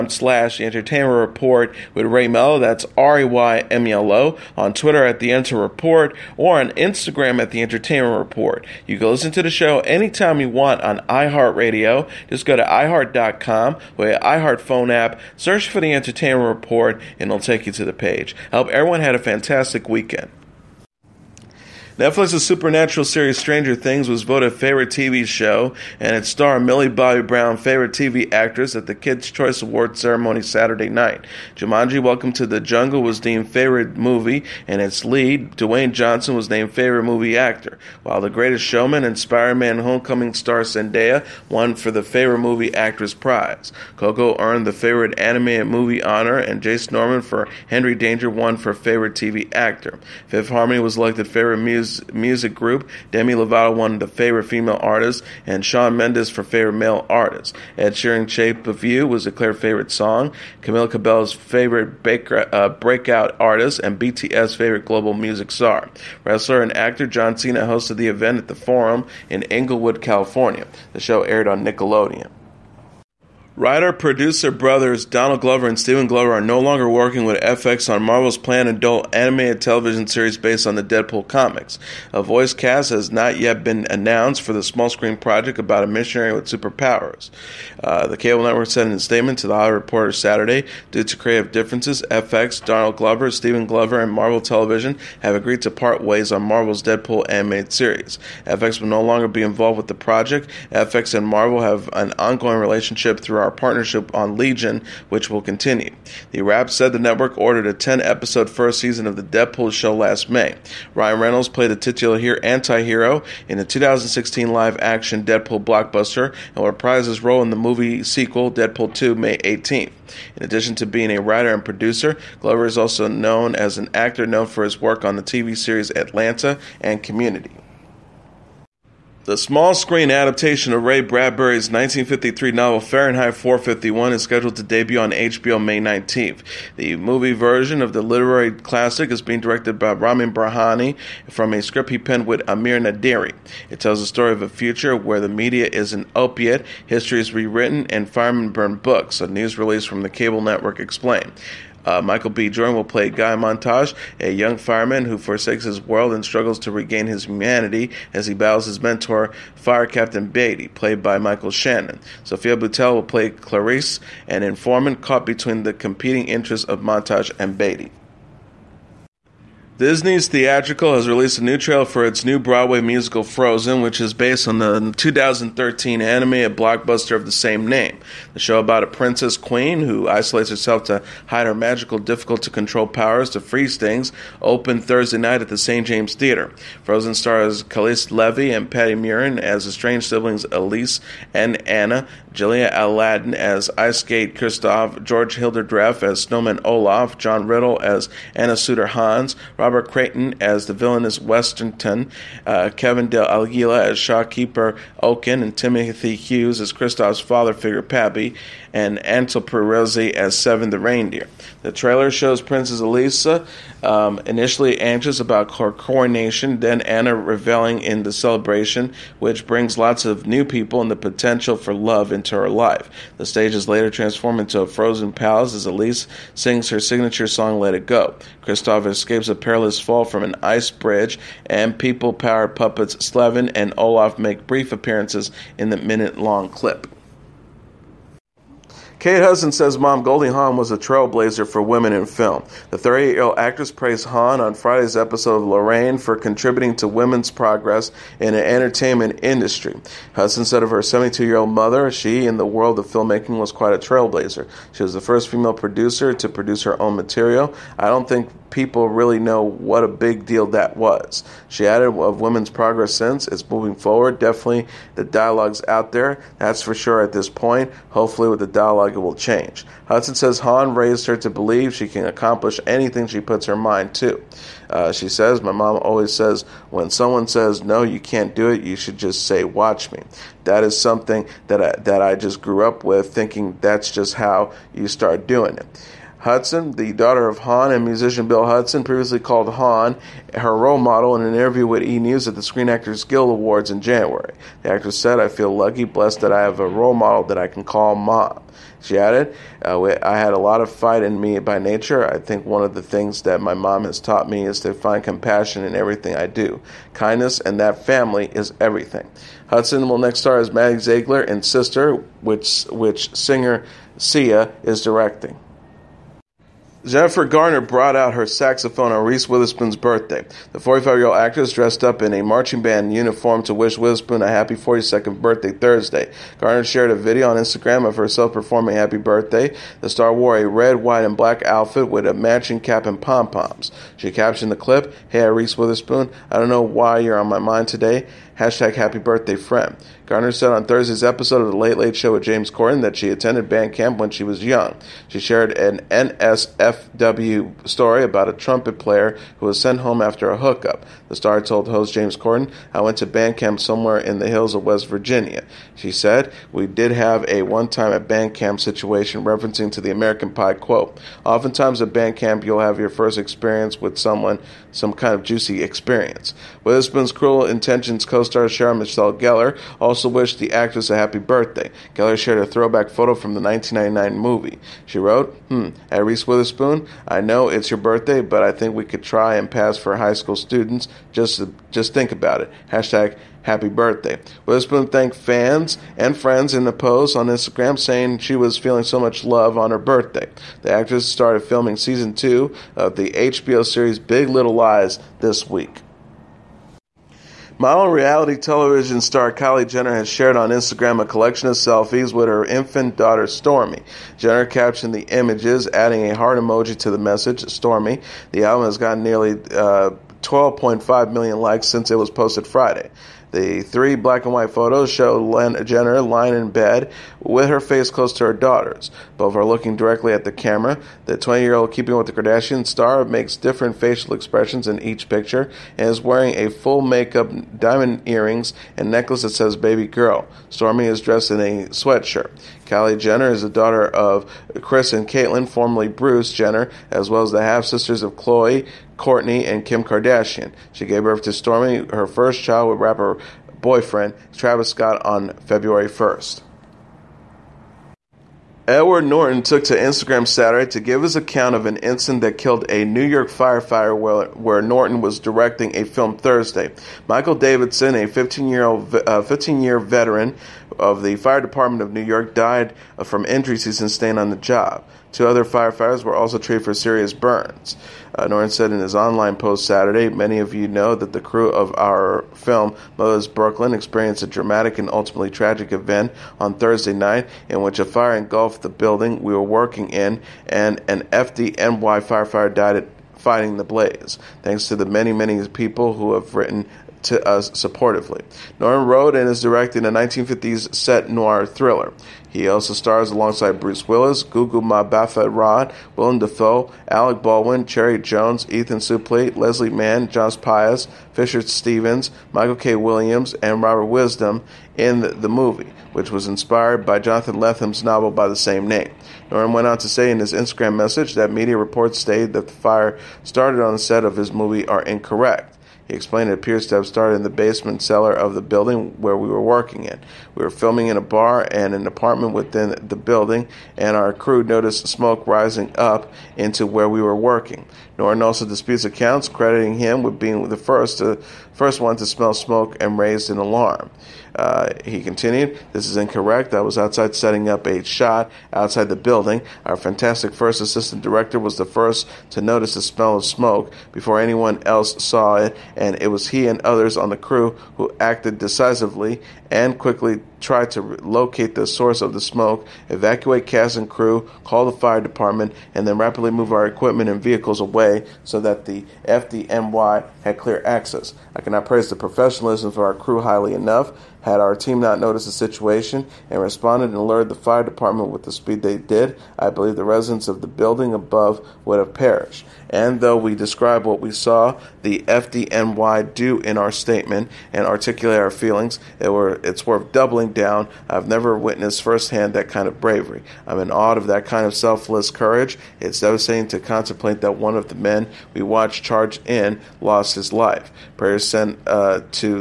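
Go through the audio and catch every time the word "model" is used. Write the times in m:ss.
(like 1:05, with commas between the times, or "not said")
4:50, 4:56.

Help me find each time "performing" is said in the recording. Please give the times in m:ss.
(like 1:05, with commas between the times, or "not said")
5:28.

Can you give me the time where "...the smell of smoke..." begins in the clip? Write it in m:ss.
9:02.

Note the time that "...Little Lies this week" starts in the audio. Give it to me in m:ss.
6:34.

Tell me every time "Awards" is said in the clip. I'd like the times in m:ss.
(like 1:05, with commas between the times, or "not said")
0:29, 4:53.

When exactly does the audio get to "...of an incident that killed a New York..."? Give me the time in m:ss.
7:31.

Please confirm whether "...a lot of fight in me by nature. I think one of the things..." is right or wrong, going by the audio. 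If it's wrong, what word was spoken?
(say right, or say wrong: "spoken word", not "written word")
right.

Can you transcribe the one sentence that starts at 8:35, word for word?
He explained it appears to have started in the basement cellar of the building where we were working in.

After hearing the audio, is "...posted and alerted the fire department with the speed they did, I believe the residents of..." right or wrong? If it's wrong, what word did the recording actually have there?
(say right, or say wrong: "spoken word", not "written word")
wrong: "responded", not "posted".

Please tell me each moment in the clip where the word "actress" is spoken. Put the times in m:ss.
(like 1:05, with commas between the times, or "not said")
0:28, 0:42, 4:03, 4:54, 5:21, 6:10, 6:30.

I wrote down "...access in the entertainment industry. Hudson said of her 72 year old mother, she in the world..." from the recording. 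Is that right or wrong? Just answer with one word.
wrong.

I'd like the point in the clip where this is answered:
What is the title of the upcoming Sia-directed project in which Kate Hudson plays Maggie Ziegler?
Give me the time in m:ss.
5:11.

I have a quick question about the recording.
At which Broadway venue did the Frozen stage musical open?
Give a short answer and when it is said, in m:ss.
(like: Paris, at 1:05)
St. James Theater, at 3:05.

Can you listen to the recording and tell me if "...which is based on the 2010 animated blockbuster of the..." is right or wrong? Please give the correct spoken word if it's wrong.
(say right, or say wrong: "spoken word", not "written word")
wrong: "2013", not "2010".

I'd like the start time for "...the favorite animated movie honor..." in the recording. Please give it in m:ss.
0:44.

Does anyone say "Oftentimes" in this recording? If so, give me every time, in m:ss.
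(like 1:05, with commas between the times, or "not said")
6:01.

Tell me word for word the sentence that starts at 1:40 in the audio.
FX and Marvel have an ongoing relationship through our our partnership on Legion, which will continue.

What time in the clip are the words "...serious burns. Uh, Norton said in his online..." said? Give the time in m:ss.
7:46.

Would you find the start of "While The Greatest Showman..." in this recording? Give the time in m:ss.
0:38.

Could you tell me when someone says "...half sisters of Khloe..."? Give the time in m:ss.
7:17.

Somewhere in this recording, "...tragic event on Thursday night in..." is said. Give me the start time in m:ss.
7:55.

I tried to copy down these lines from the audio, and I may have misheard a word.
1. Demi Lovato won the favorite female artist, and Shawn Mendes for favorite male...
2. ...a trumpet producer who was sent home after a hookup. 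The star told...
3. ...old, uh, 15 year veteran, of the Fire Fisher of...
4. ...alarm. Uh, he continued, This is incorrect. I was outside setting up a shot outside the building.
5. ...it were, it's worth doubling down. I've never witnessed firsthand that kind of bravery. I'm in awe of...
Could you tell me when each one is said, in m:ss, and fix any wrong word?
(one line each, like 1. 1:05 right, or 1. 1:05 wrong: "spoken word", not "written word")
1. 0:53 right
2. 5:48 wrong: "player", not "producer"
3. 7:38 wrong: "Department", not "Fisher"
4. 8:53 right
5. 9:38 right.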